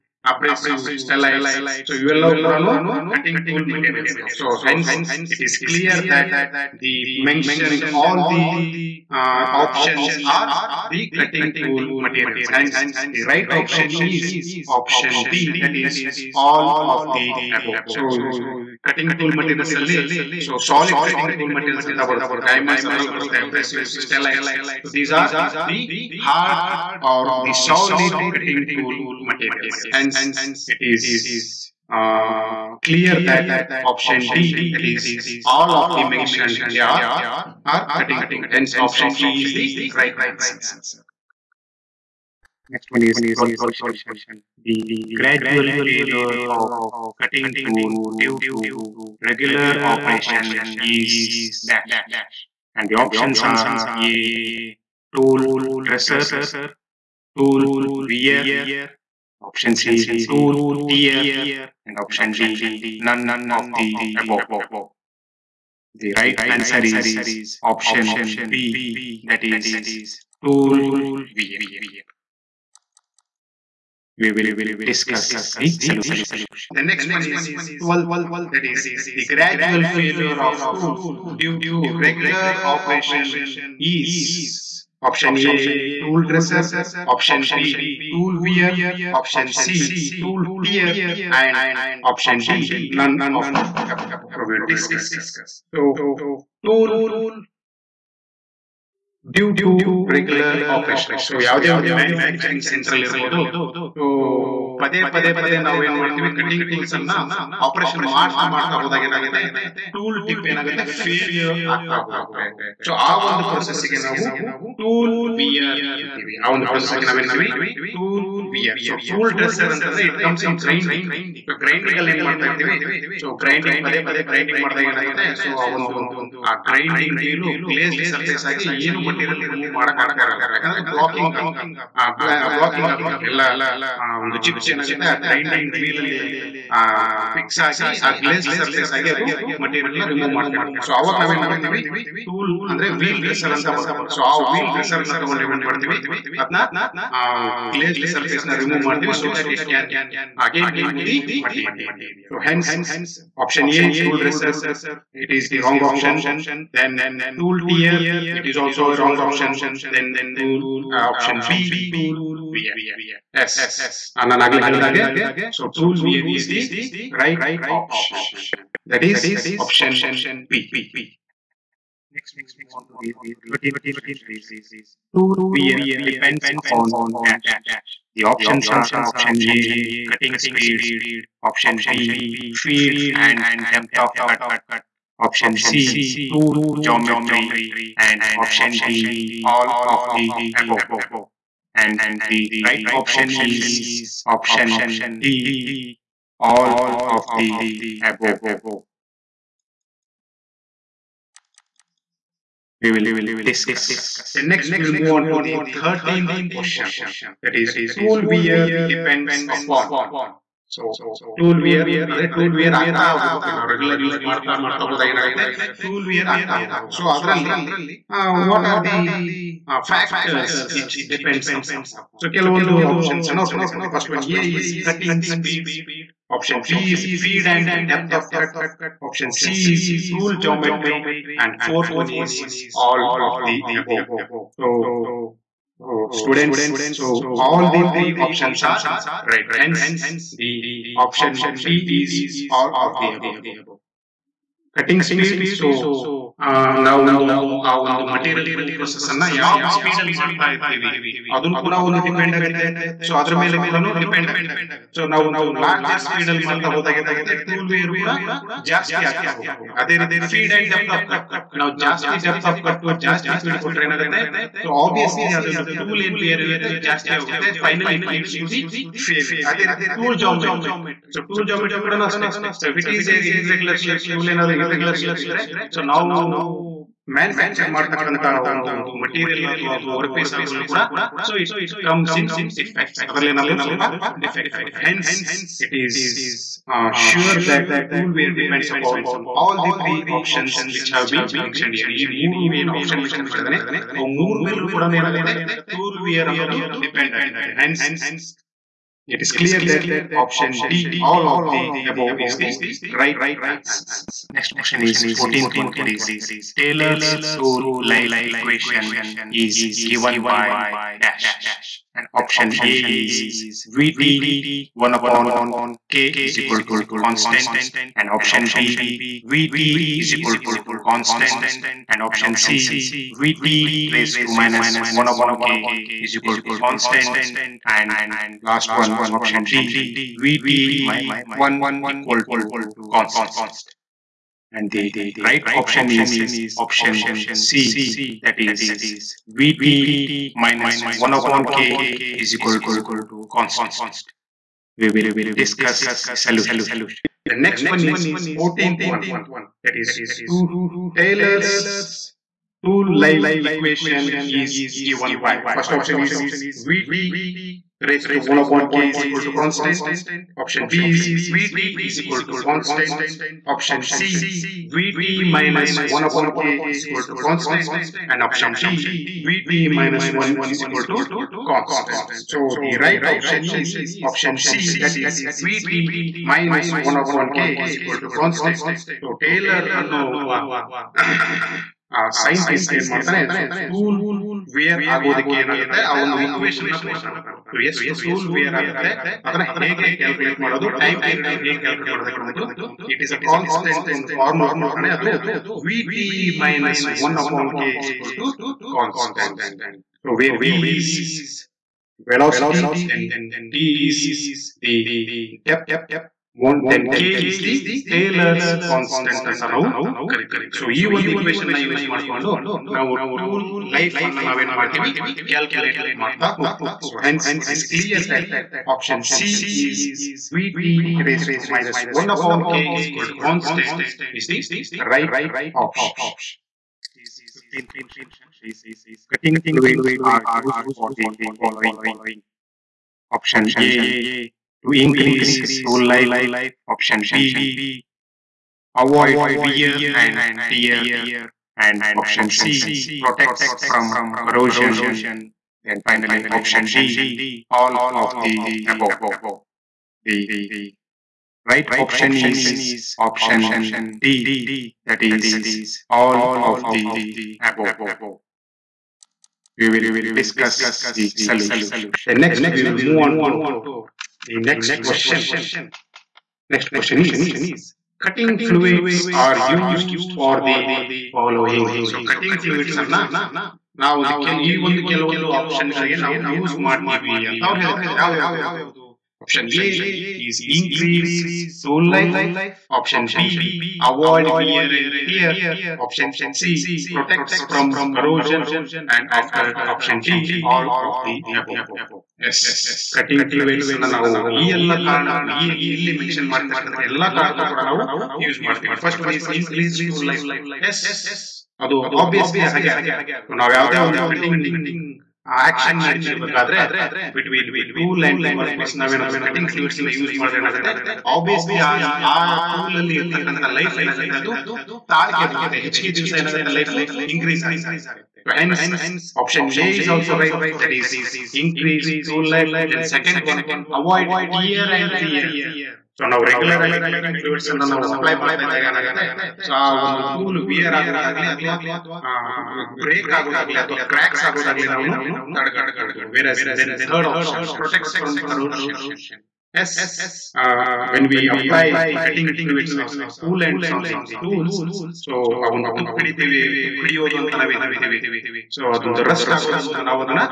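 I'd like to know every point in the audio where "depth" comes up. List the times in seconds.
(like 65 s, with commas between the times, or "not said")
183 s, 227 s.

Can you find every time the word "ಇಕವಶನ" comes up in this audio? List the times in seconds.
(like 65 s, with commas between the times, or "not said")
308 s, 386 s.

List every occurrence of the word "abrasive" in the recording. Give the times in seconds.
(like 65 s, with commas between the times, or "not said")
0 s, 23 s.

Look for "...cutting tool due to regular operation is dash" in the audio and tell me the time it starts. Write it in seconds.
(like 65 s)
47 s.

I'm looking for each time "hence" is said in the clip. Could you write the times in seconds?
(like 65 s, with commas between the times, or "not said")
4 s, 12 s, 29 s, 38 s, 239 s, 417 s.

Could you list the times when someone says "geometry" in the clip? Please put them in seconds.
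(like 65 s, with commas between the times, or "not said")
186 s, 230 s.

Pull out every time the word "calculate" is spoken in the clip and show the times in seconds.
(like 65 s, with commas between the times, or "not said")
415 s.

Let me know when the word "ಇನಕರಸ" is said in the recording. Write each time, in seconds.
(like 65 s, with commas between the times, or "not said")
499 s, 517 s, 521 s.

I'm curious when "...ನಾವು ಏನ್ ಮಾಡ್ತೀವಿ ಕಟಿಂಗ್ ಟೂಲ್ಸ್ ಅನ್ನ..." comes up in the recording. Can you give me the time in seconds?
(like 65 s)
105 s.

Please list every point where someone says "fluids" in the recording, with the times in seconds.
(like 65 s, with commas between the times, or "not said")
429 s, 468 s, 472 s.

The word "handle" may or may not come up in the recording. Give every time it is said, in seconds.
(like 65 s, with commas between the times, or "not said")
not said.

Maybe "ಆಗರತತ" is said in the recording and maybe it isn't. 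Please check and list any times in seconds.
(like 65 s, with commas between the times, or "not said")
297 s.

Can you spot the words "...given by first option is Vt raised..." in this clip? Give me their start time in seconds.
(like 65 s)
354 s.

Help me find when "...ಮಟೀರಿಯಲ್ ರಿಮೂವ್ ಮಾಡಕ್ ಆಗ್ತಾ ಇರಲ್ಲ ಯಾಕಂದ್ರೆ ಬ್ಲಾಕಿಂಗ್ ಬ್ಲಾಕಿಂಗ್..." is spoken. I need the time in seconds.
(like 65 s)
129 s.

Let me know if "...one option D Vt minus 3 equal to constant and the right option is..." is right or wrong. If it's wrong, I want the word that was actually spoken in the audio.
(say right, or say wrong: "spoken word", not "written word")
wrong: "1", not "3".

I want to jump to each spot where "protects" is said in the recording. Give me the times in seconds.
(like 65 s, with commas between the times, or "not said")
442 s, 486 s.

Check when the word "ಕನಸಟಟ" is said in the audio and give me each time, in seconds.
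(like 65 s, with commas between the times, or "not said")
317 s, 378 s, 393 s, 398 s.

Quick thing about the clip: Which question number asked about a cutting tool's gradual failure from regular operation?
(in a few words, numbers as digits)
12.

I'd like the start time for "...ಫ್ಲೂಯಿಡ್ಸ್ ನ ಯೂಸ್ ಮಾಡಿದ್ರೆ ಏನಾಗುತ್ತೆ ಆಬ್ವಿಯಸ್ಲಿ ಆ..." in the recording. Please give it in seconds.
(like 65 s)
509 s.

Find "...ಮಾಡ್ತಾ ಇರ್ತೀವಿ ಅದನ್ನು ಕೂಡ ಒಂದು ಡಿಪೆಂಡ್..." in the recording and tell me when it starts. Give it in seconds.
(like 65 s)
250 s.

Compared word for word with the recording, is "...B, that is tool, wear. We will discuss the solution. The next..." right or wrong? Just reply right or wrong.
right.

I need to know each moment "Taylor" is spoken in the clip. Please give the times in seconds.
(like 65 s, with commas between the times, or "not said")
350 s, 407 s.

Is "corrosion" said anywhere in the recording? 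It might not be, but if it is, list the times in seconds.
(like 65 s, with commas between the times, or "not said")
444 s, 487 s.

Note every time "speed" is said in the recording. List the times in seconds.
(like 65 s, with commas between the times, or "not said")
180 s, 225 s, 245 s.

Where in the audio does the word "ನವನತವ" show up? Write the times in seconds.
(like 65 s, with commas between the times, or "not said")
117 s.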